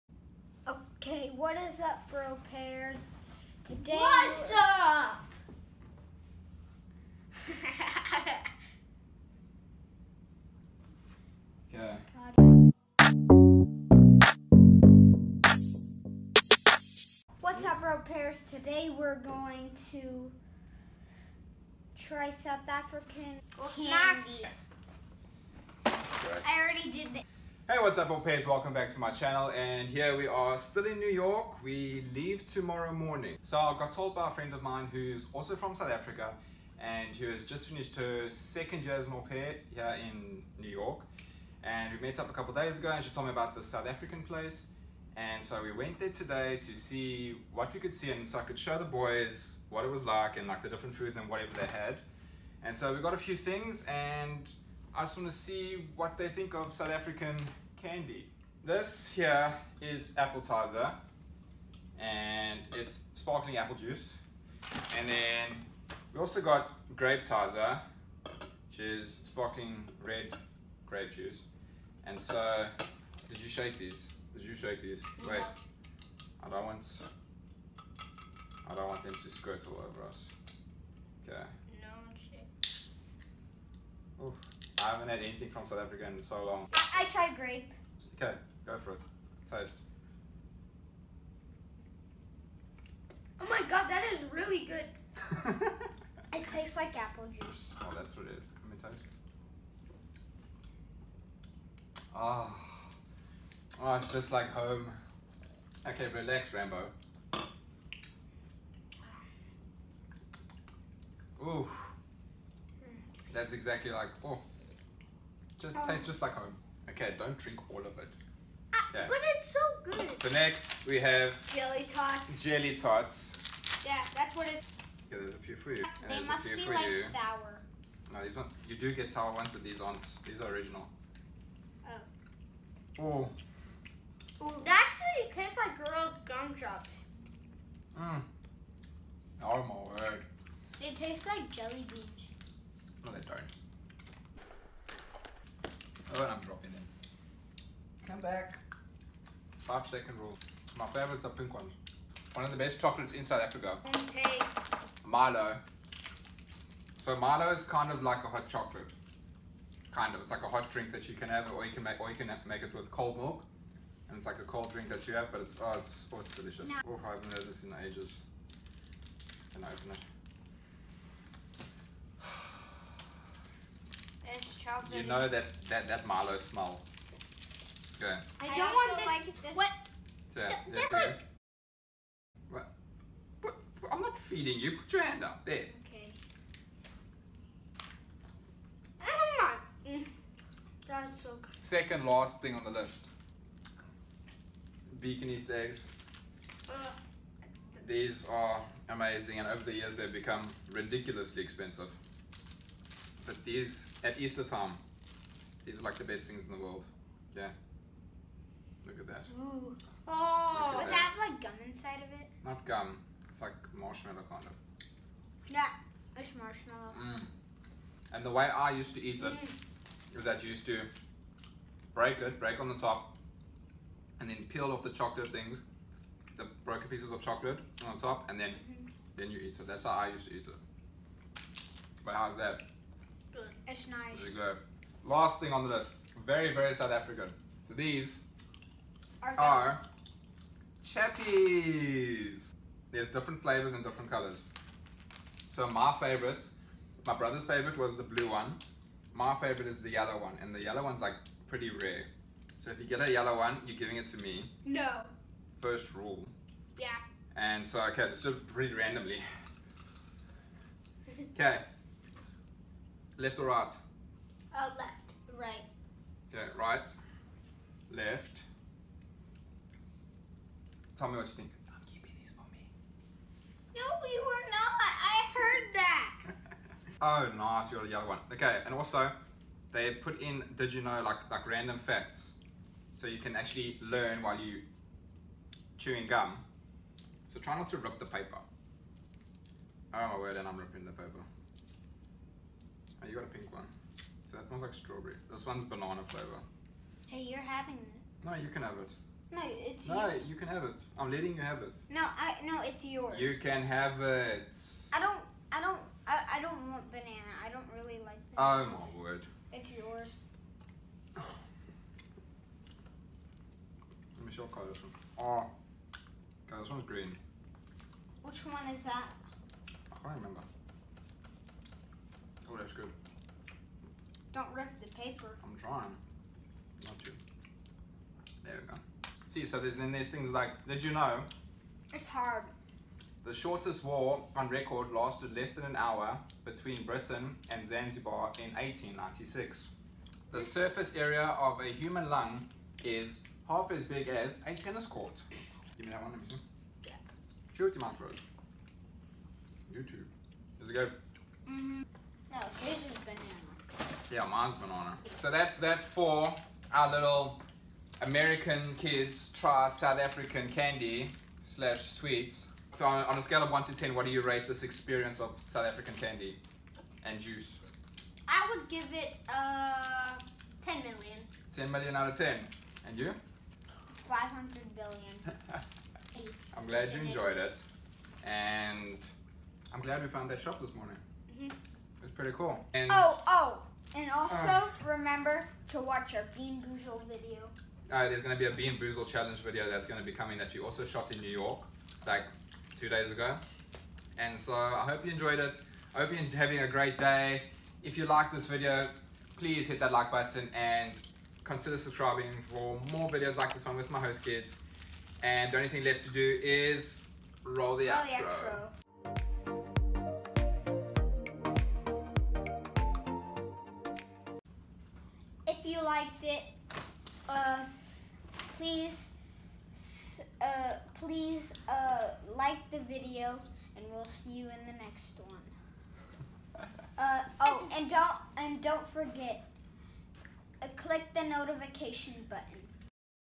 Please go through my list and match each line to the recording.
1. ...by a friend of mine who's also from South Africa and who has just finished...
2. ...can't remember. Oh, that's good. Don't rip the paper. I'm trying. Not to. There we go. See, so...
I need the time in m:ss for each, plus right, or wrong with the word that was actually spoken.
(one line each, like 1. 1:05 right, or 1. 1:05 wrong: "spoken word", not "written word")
1. 0:34 right
2. 5:20 right.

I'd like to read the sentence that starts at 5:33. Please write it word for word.
The shortest war on record lasted less than an hour between Britain and Zanzibar in 1896.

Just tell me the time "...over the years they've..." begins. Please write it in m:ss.
3:19.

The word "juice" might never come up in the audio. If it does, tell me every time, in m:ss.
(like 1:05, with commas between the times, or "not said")
1:03, 1:11, 1:37, 6:07.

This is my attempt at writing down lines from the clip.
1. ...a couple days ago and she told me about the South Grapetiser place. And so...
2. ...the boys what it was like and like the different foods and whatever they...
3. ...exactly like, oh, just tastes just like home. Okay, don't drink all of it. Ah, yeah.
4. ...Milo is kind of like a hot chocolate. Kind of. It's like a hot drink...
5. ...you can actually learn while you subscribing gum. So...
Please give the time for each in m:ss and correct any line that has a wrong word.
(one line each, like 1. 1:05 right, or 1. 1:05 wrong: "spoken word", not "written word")
1. 0:42 wrong: "African", not "Grapetiser"
2. 0:48 right
3. 1:53 right
4. 2:37 right
5. 4:43 wrong: "chewing", not "subscribing".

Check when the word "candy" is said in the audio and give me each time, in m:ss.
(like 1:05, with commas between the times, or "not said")
0:23, 0:57, 6:00, 6:05.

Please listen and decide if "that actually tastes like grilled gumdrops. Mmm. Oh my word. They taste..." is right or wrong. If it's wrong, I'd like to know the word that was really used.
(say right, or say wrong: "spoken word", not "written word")
right.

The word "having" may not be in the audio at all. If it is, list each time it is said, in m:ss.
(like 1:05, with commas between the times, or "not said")
4:57, 6:36.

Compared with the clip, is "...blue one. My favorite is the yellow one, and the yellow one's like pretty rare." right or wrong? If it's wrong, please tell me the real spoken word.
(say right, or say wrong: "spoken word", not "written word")
right.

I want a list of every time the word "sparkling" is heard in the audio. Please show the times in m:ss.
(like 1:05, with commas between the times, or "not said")
1:03, 1:09.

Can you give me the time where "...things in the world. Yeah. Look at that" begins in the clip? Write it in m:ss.
3:26.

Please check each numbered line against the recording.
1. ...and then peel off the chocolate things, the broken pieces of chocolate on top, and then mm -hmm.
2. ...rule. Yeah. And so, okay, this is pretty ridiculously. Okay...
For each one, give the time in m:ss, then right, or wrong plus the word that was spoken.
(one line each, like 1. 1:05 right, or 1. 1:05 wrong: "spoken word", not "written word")
1. 3:44 right
2. 4:15 wrong: "randomly", not "ridiculously".